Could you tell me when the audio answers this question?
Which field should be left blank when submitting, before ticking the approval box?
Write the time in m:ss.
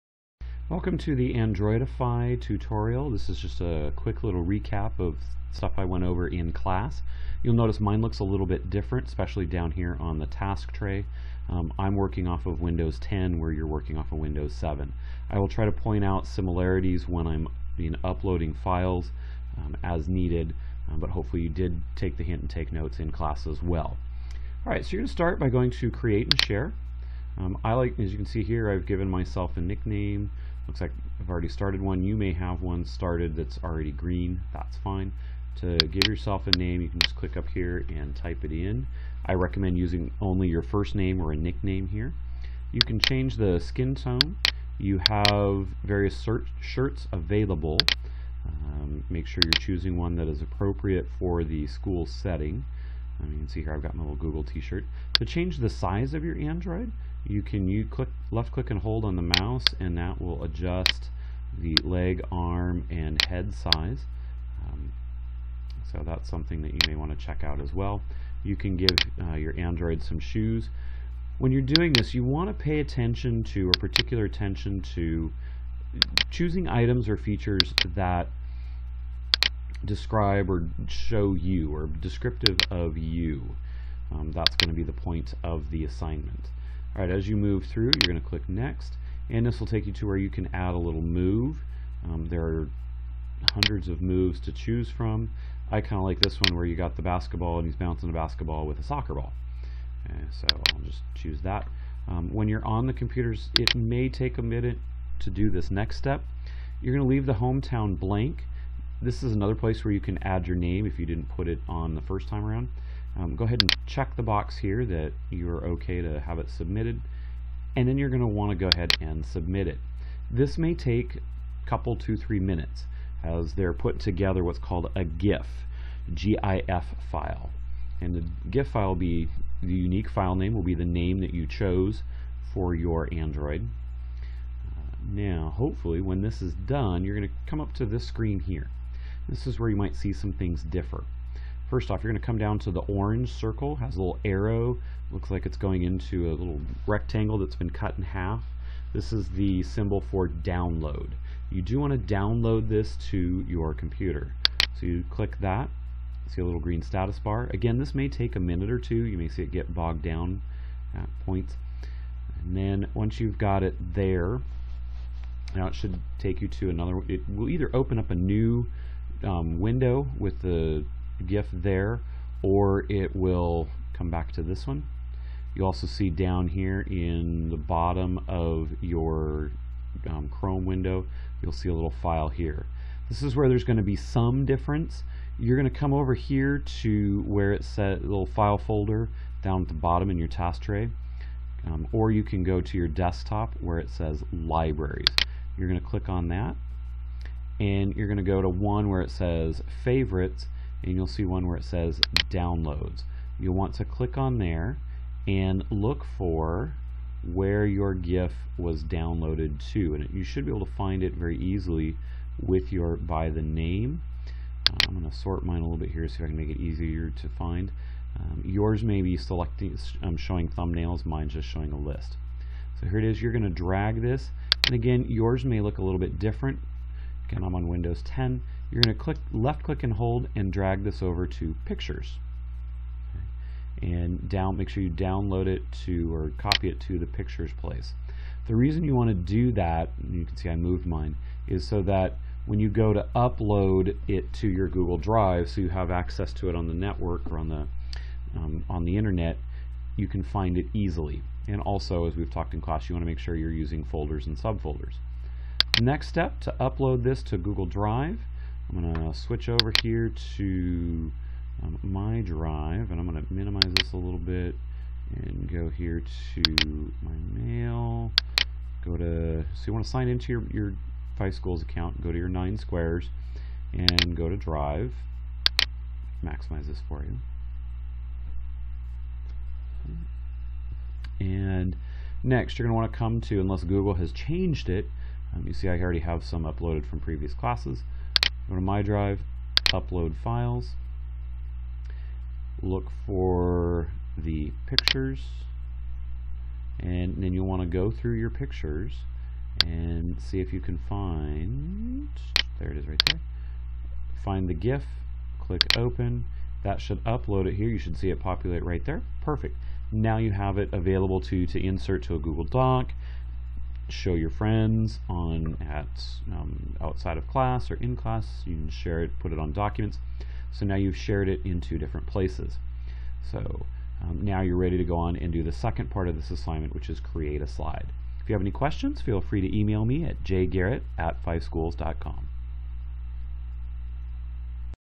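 1:47.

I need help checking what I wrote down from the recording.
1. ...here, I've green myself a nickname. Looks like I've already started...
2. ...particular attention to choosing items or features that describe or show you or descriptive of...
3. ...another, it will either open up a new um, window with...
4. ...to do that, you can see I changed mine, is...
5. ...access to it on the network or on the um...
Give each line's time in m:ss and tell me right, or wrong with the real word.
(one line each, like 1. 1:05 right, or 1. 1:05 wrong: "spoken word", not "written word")
1. 0:28 wrong: "given", not "green"
2. 1:13 right
3. 2:46 right
4. 3:59 wrong: "moved", not "changed"
5. 4:05 right.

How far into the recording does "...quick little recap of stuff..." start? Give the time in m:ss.
0:03.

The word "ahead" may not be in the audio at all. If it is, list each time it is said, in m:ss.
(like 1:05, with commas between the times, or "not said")
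1:53, 1:58.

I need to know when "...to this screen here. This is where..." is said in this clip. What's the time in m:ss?
2:17.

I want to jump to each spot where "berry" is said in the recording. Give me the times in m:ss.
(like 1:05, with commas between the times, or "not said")
not said.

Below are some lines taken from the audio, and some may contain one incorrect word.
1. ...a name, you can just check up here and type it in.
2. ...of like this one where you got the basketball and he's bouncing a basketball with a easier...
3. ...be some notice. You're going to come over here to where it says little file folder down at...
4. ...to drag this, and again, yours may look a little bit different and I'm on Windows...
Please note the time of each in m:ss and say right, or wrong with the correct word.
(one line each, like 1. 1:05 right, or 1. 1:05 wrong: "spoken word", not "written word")
1. 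0:36 wrong: "click", not "check"
2. 1:35 wrong: "soccer", not "easier"
3. 3:03 wrong: "difference", not "notice"
4. 3:43 right.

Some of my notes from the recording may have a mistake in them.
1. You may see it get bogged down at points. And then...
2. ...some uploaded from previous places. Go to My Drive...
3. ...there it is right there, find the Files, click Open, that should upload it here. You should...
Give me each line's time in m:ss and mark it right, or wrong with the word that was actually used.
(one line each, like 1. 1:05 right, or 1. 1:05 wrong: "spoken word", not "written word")
1. 2:39 right
2. 4:46 wrong: "classes", not "places"
3. 5:02 wrong: "GIF", not "Files".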